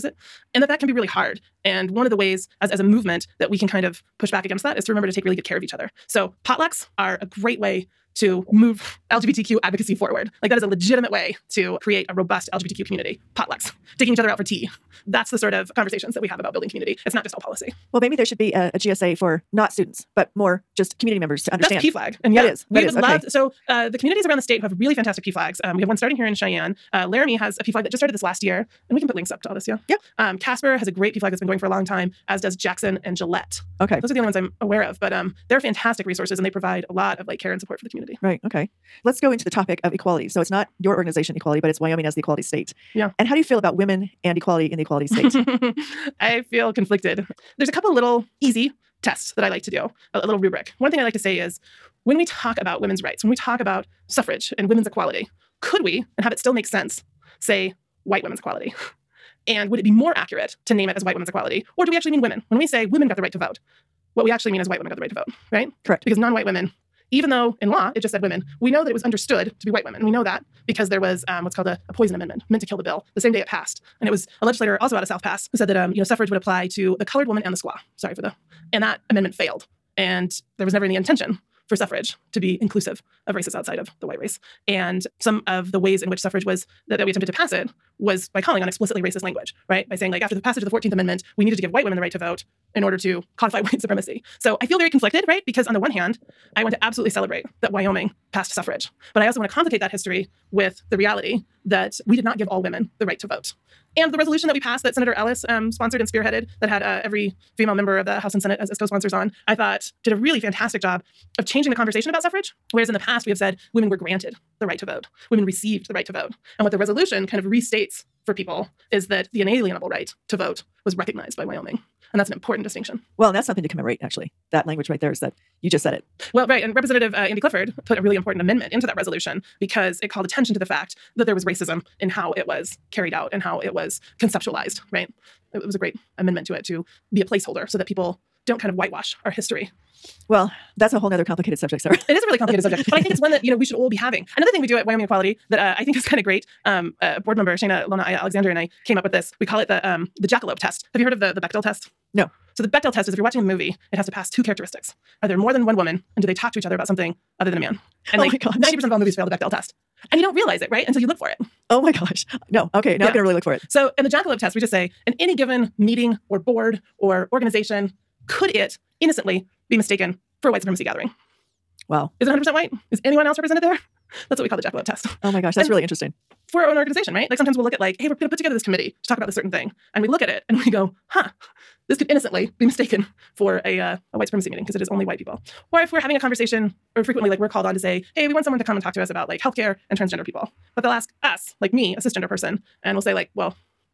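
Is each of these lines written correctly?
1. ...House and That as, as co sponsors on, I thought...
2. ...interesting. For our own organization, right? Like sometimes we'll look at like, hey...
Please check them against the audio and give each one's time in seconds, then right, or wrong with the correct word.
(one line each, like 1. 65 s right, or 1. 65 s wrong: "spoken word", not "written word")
1. 108 s wrong: "Senate", not "That"
2. 175 s right.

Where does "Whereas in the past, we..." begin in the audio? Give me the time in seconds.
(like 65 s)
112 s.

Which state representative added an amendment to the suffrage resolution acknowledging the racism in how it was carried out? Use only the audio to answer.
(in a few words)
Andy Clifford.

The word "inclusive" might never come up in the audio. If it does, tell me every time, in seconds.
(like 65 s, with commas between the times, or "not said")
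82 s.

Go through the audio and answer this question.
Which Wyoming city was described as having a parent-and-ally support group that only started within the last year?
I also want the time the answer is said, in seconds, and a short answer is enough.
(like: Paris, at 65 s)
Laramie, at 27 s.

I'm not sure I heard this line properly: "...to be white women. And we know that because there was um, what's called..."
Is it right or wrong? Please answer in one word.
right.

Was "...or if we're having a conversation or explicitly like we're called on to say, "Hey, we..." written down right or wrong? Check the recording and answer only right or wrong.
wrong.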